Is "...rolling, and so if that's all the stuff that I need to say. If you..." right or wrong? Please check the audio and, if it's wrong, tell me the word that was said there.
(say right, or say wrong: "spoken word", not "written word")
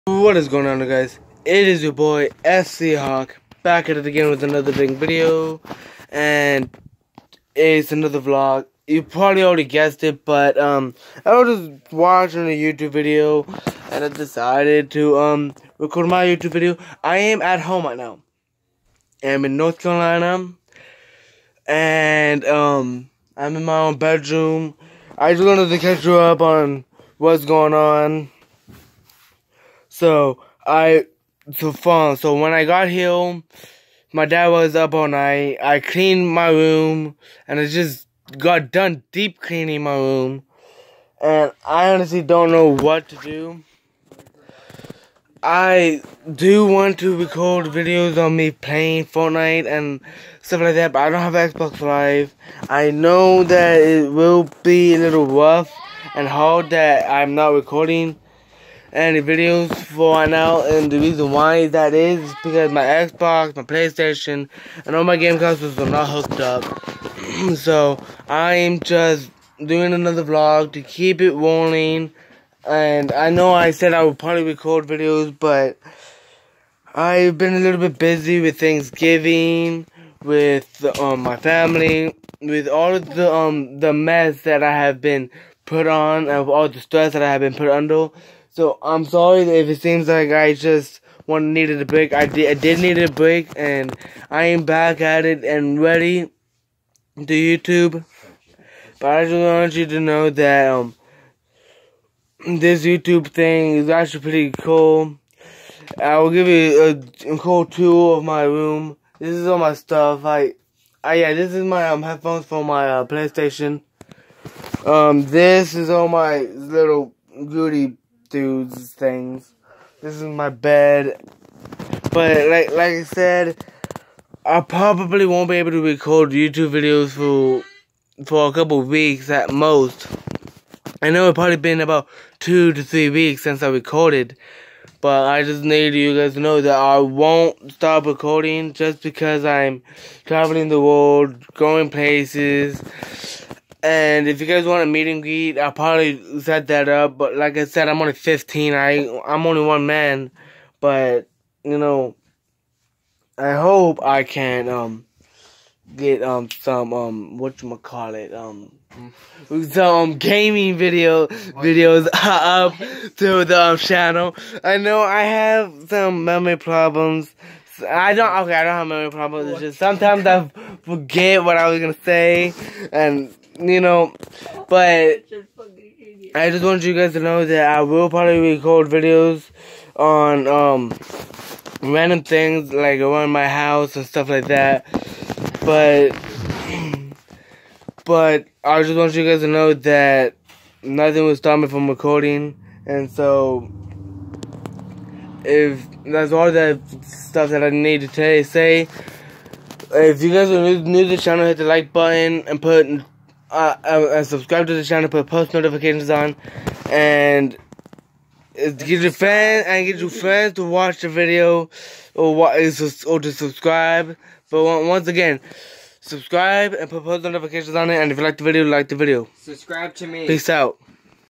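wrong: "recording", not "rolling".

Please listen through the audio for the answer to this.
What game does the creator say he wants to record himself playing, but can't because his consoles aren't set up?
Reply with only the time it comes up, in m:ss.
0:49.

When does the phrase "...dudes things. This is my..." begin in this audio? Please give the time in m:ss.
1:58.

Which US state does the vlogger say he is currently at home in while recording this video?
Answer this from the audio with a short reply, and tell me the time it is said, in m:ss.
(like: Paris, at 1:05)
North Carolina, at 0:19.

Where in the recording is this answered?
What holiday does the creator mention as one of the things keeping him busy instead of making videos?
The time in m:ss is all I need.
1:18.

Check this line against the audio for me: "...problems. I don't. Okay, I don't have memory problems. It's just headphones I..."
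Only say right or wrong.
wrong.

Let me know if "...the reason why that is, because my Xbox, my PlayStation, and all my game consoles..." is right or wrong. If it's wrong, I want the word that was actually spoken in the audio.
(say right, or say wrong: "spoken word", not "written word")
right.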